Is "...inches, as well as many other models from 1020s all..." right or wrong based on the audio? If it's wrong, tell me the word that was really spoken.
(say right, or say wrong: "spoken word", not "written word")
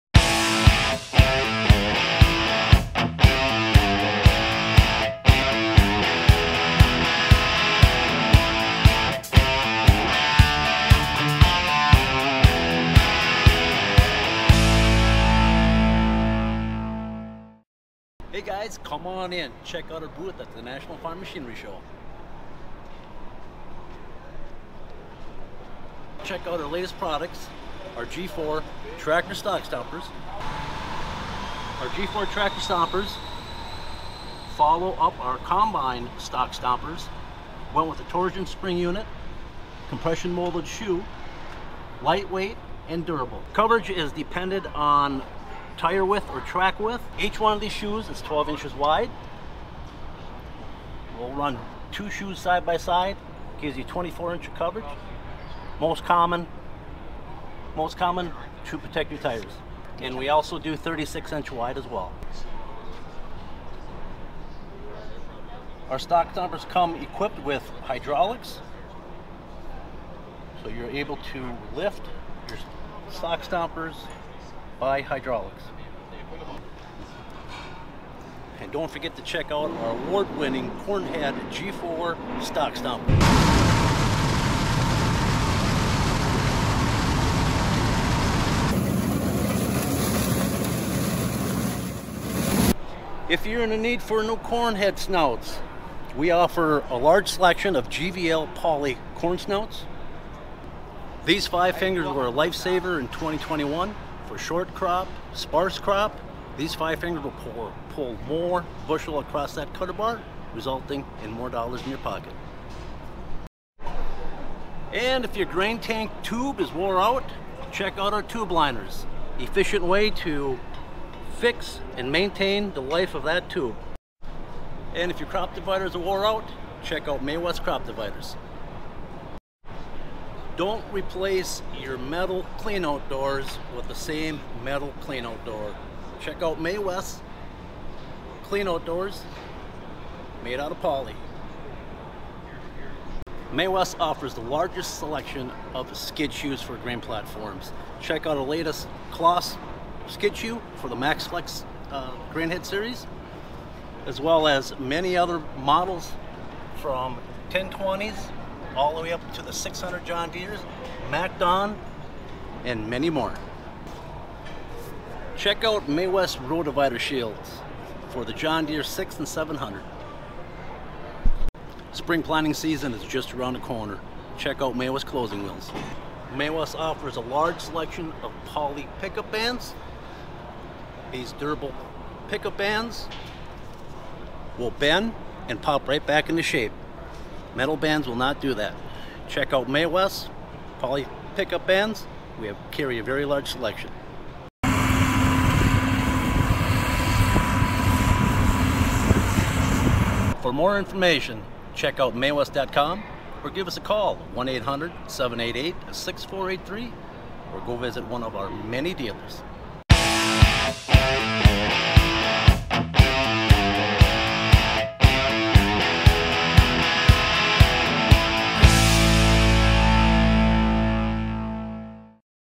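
wrong: "series", not "inches".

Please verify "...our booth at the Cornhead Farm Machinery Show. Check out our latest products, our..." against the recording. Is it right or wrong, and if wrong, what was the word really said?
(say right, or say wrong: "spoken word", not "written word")
wrong: "National", not "Cornhead".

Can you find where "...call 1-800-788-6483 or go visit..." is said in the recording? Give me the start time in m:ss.
3:23.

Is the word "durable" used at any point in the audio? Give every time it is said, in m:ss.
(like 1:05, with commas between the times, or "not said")
0:43, 3:01.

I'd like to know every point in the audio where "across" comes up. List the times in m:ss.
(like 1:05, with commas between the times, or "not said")
1:49.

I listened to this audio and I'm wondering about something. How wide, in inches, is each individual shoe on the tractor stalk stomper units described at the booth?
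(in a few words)
12 inches.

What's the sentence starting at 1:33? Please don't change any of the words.
If you're in the need for new cornhead snouts, we offer a large selection of GVL poly corn snouts.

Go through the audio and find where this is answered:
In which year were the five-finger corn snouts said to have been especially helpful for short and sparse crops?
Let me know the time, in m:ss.
1:43.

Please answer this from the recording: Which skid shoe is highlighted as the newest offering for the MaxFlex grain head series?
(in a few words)
Kloss skid shoe.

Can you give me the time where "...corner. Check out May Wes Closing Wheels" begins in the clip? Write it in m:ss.
2:53.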